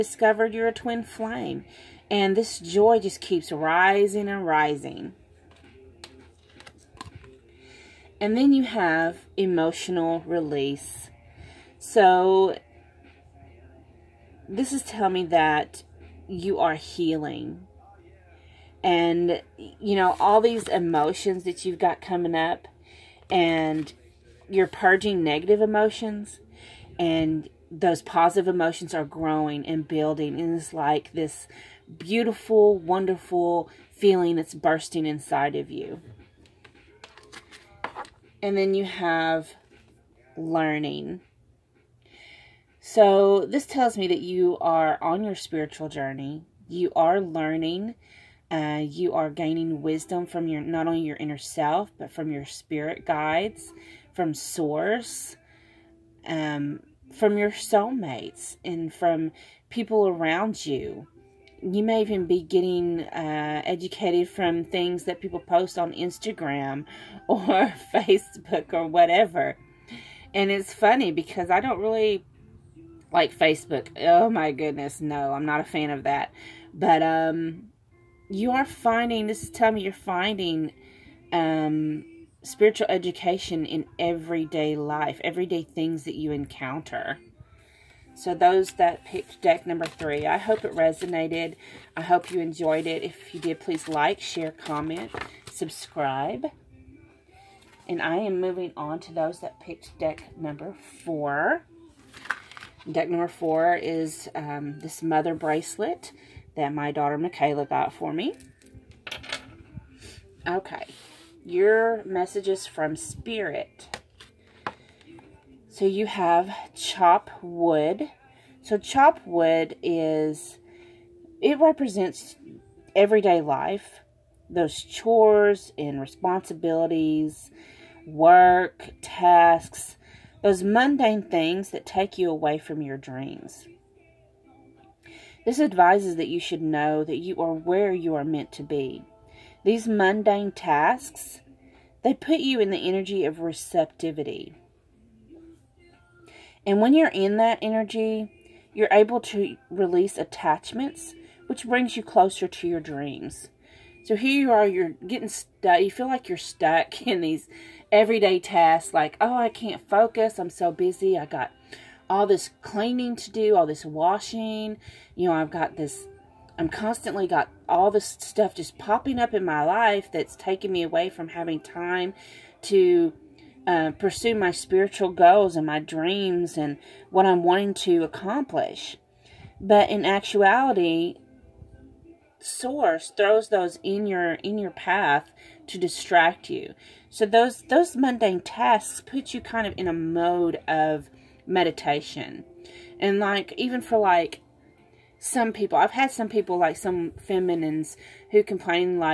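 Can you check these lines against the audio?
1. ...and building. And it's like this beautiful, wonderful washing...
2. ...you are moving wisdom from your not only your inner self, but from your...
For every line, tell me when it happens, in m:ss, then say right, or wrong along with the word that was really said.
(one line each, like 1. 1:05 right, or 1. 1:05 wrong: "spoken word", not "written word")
1. 0:29 wrong: "feeling", not "washing"
2. 0:48 wrong: "gaining", not "moving".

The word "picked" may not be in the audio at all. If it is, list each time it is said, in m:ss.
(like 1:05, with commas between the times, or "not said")
1:29, 1:39.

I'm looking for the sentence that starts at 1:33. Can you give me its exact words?
If you did, please like, share, comment, subscribe.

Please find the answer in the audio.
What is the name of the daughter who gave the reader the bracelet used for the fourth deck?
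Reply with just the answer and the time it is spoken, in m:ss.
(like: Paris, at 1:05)
Michaela, at 1:47.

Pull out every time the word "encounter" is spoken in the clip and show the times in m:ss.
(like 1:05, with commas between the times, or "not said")
1:26.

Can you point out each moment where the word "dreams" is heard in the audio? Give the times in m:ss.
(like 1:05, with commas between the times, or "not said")
2:12, 2:32, 2:55.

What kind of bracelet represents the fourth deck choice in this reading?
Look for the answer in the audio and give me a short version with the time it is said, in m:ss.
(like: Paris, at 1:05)
mother bracelet, at 1:45.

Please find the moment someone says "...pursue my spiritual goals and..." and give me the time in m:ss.
2:53.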